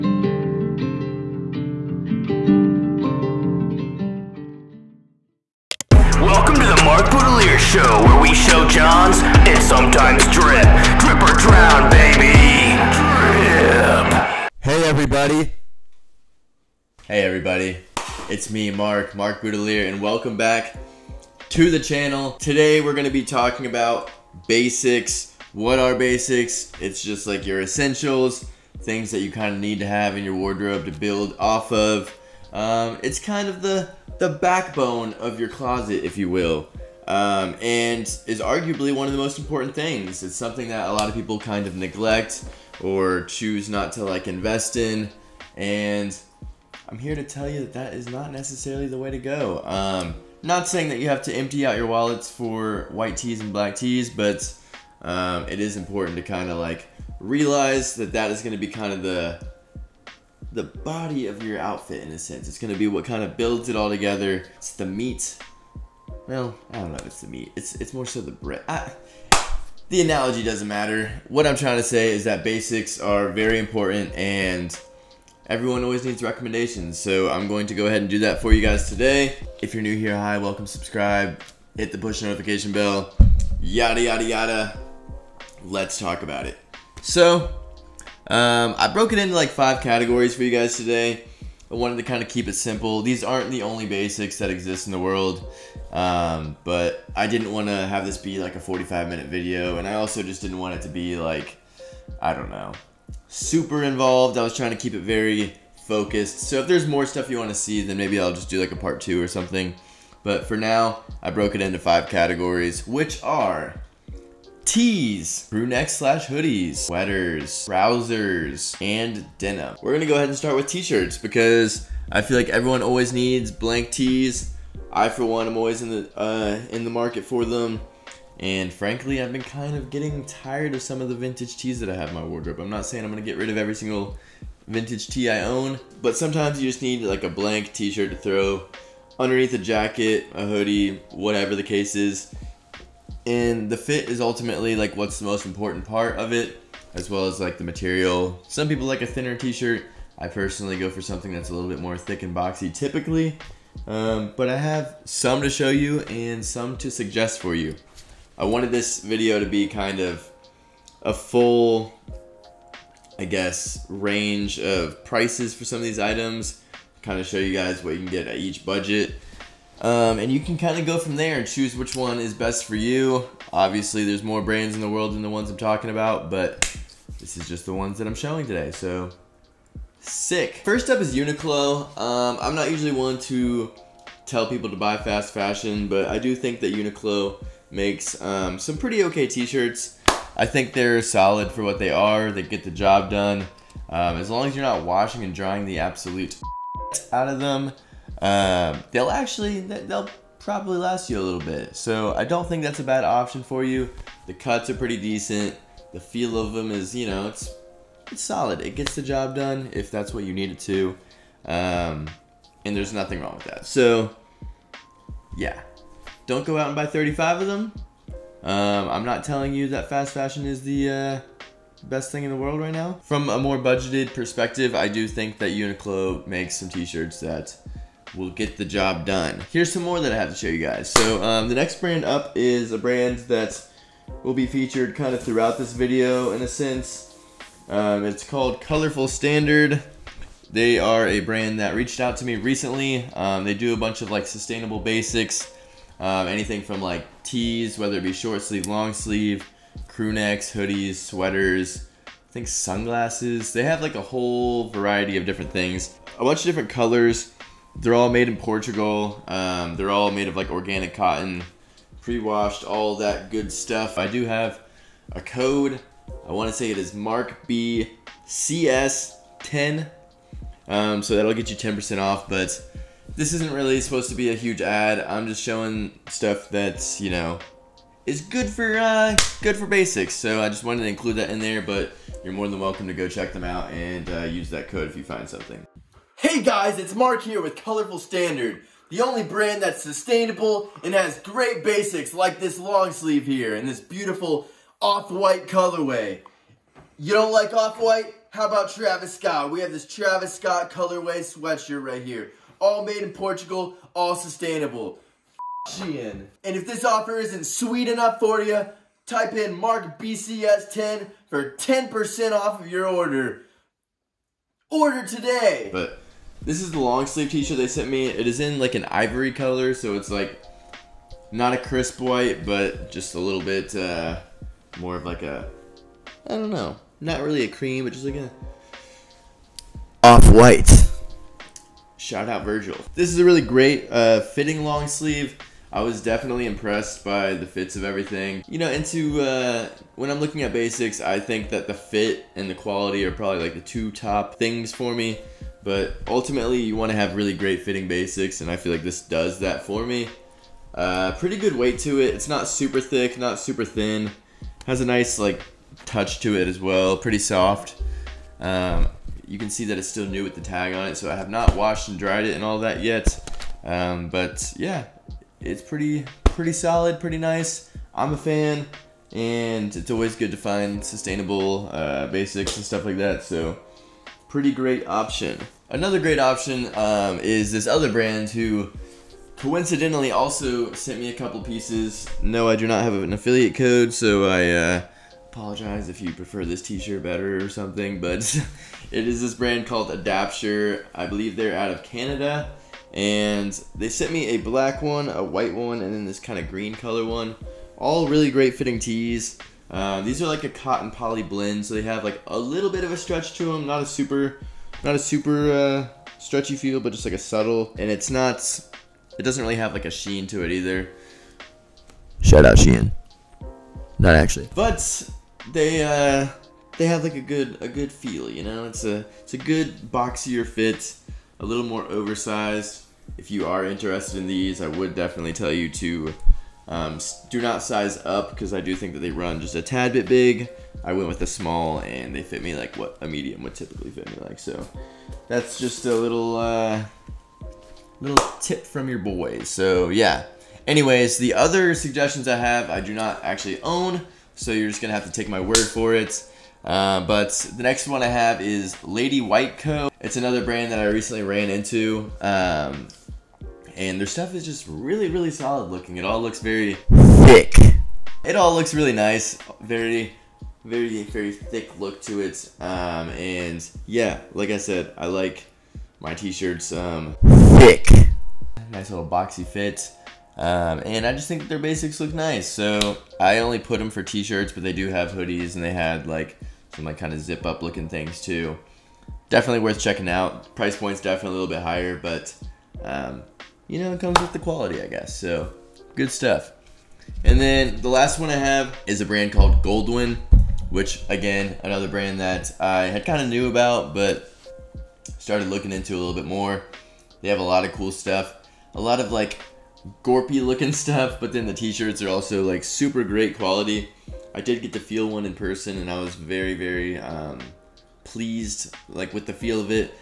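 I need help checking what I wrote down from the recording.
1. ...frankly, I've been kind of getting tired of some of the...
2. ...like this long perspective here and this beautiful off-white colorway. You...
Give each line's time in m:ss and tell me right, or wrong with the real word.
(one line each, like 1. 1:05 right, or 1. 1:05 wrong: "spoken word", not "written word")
1. 2:08 right
2. 4:52 wrong: "sleeve", not "perspective".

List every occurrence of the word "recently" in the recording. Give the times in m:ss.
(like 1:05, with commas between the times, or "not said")
4:02, 7:30.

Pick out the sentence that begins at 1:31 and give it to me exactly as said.
I wanted to kind of keep it simple.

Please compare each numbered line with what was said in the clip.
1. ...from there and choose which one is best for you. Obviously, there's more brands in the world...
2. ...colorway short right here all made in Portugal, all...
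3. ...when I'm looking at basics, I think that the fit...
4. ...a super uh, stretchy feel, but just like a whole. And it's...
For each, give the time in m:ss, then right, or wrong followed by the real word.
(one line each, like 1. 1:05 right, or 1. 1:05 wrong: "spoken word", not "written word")
1. 2:50 right
2. 5:00 wrong: "sweatshirt", not "short"
3. 5:39 right
4. 6:44 wrong: "subtle", not "whole".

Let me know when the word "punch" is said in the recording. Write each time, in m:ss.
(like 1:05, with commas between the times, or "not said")
not said.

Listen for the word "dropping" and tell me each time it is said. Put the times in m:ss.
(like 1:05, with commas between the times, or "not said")
not said.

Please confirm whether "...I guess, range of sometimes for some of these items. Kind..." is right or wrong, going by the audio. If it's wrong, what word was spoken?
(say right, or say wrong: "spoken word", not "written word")
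wrong: "prices", not "sometimes".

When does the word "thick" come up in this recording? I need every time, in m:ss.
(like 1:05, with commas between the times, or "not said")
2:31, 5:52, 7:37, 7:41, 7:47.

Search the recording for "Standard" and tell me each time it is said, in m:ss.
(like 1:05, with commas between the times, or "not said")
3:59, 4:47.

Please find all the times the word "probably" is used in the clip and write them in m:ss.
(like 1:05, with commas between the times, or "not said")
3:20, 5:43.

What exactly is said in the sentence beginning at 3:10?
I think they're solid for what they are.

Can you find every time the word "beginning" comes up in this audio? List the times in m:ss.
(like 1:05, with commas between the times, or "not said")
not said.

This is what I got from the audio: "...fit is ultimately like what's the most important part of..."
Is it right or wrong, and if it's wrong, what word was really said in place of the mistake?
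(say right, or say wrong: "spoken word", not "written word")
right.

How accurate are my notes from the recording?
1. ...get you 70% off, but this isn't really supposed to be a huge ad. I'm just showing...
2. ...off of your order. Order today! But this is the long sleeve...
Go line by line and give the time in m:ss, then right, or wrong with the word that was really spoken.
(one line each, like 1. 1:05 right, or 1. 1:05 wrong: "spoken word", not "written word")
1. 4:31 wrong: "10", not "70"
2. 5:12 right.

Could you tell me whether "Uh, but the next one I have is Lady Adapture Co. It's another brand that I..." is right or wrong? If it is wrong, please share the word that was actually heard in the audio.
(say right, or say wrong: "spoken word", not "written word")
wrong: "White", not "Adapture".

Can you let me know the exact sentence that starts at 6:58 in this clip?
It's a it's a good boxier fit, a little more oversized.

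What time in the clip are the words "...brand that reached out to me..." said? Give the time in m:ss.
4:01.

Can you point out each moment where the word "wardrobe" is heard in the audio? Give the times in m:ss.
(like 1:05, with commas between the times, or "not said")
0:30, 2:12.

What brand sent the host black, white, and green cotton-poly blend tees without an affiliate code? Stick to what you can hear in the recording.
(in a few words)
Adapture.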